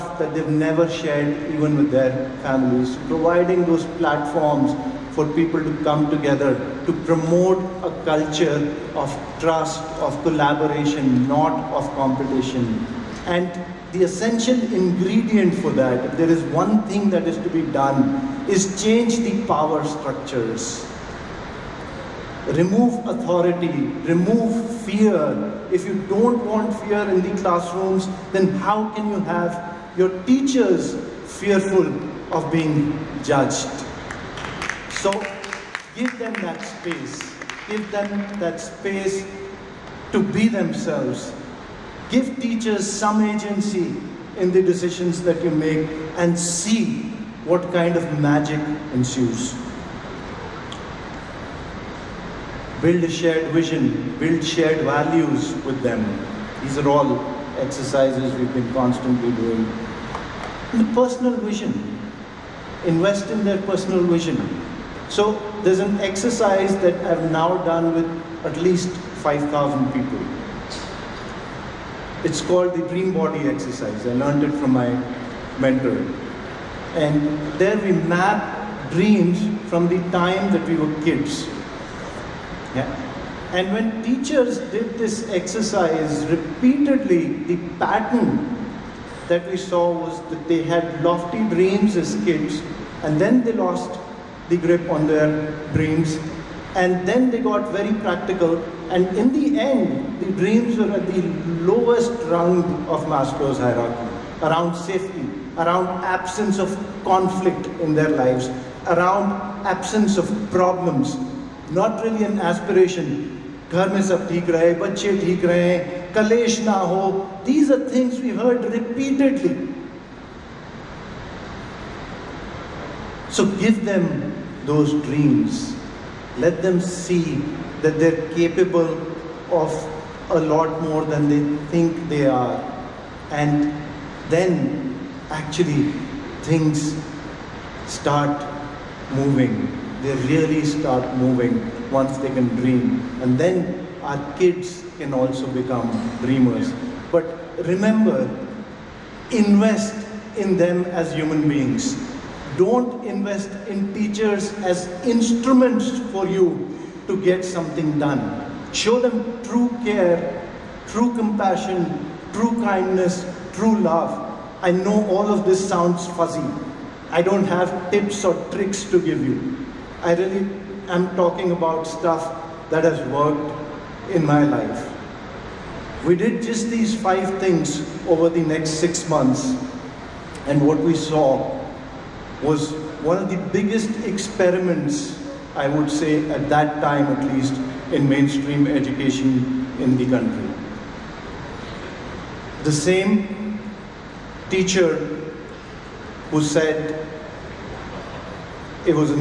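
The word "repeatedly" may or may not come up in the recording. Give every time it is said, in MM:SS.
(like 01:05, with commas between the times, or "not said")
01:26, 01:58.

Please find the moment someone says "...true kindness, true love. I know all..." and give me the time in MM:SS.
02:42.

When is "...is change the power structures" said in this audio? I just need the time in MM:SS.
00:18.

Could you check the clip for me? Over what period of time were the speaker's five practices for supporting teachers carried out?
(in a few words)
6 months.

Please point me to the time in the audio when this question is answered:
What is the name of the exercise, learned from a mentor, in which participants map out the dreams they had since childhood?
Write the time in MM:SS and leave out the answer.
01:12.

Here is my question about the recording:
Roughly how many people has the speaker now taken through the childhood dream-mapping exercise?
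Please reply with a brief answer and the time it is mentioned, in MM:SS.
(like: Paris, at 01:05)
5,000, at 01:08.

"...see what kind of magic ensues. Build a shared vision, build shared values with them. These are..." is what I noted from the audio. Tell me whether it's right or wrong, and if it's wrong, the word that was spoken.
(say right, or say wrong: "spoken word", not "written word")
right.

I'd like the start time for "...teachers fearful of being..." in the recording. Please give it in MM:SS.
00:30.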